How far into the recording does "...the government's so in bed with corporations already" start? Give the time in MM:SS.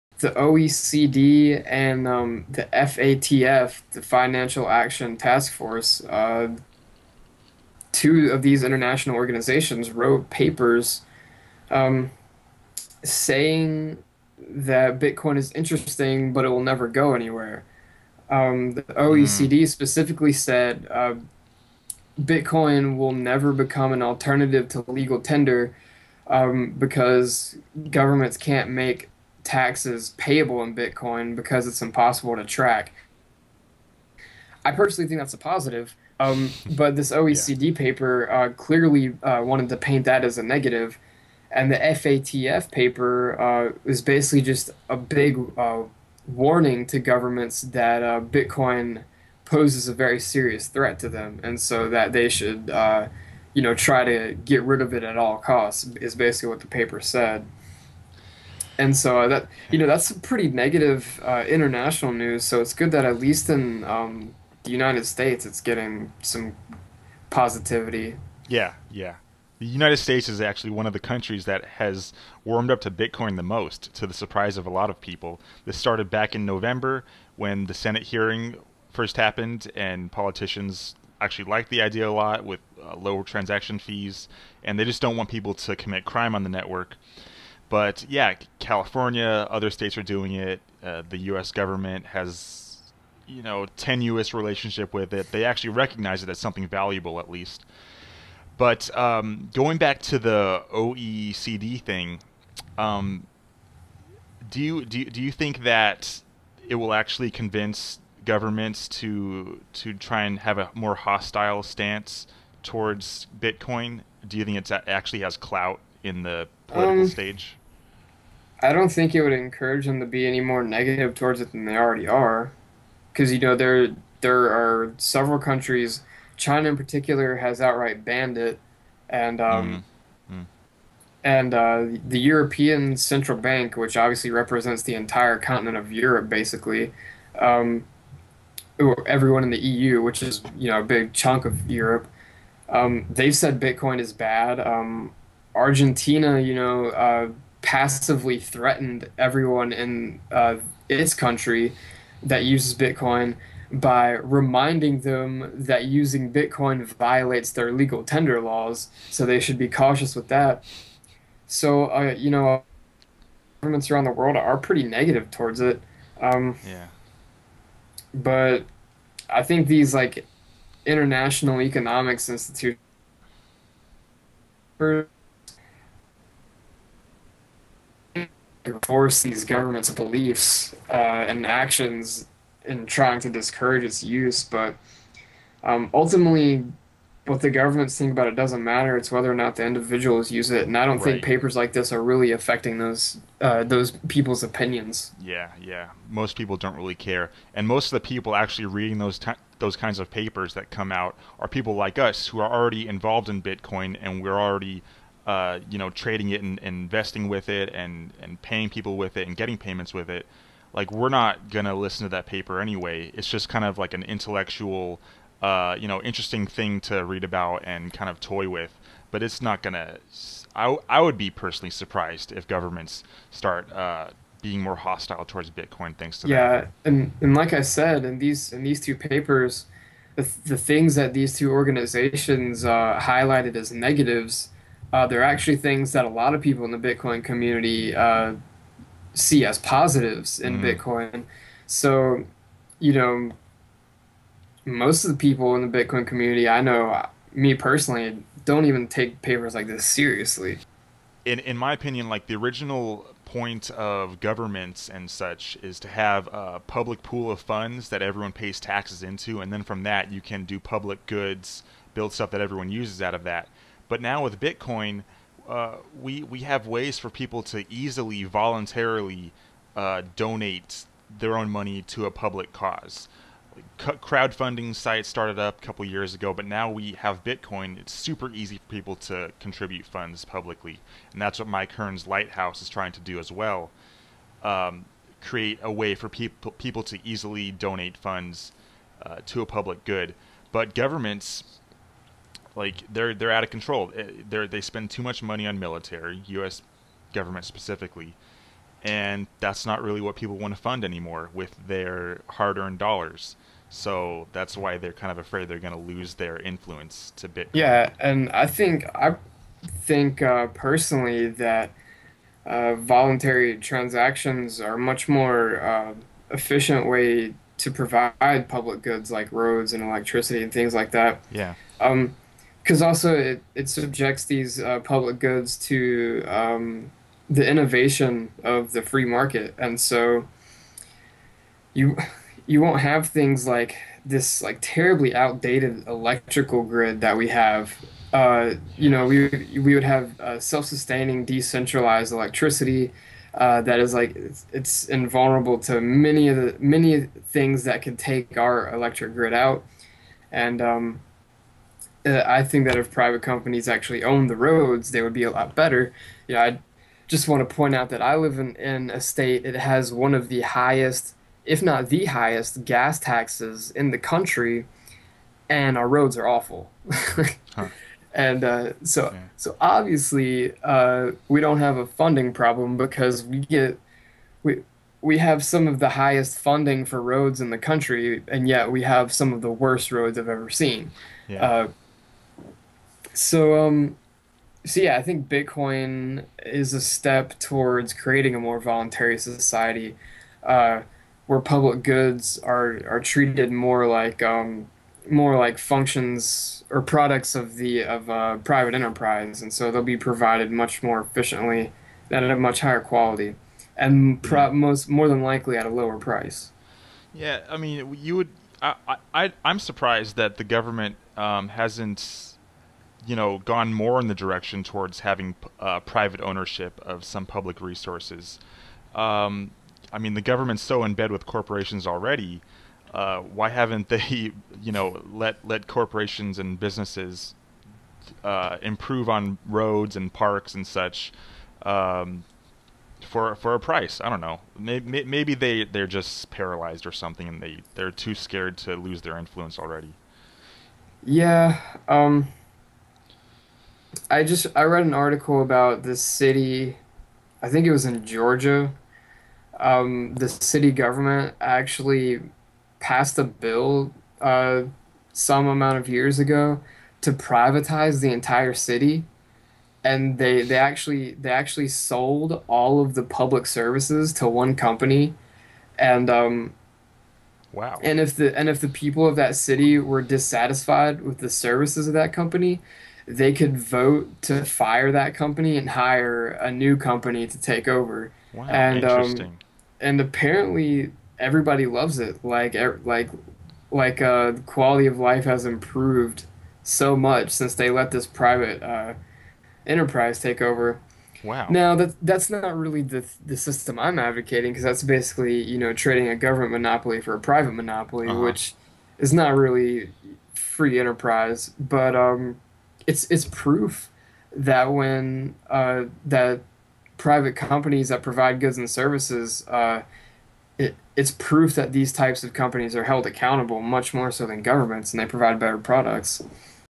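07:00.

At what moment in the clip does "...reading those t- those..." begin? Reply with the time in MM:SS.
03:18.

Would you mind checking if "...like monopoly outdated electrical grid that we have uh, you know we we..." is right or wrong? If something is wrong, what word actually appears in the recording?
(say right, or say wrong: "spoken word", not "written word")
wrong: "terribly", not "monopoly".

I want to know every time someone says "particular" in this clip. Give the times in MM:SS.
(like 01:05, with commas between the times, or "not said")
02:06.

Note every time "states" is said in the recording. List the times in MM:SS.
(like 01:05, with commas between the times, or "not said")
01:05, 01:09, 01:29, 05:59.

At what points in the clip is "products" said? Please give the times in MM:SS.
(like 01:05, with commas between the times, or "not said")
06:36, 08:35.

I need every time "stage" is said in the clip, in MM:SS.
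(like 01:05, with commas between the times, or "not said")
01:57.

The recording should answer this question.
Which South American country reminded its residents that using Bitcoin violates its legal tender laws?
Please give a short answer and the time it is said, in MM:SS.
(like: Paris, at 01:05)
Argentina, at 02:25.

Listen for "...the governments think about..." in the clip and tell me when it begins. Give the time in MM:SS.
03:07.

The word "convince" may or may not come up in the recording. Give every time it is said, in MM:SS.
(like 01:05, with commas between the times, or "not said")
01:47.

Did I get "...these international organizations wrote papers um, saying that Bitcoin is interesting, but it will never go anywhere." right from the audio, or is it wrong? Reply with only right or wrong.
right.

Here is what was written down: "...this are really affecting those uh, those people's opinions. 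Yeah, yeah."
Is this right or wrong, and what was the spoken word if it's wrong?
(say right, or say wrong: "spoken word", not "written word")
right.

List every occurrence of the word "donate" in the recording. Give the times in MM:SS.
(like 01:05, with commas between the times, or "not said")
04:30, 04:47.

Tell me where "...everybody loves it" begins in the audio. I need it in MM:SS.
08:01.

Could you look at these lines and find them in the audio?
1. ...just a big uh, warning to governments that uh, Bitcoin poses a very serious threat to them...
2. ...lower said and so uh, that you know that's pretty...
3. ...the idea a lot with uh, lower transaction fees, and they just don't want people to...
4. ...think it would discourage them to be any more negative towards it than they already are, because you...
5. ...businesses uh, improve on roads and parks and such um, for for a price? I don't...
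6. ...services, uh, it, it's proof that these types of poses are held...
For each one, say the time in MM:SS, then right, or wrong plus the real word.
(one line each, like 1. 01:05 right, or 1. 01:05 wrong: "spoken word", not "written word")
1. 00:44 right
2. 00:56 wrong: "paper", not "lower"
3. 01:21 right
4. 01:58 wrong: "encourage", not "discourage"
5. 07:06 right
6. 08:28 wrong: "companies", not "poses".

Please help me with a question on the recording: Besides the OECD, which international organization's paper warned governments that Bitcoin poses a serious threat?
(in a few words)
Financial Action Task Force.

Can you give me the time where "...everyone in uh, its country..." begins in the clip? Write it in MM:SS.
02:29.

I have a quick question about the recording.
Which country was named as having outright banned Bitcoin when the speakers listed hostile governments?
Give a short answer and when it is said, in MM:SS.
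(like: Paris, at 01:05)
China, at 02:06.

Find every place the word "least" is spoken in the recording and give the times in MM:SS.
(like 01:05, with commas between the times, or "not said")
01:03, 01:37.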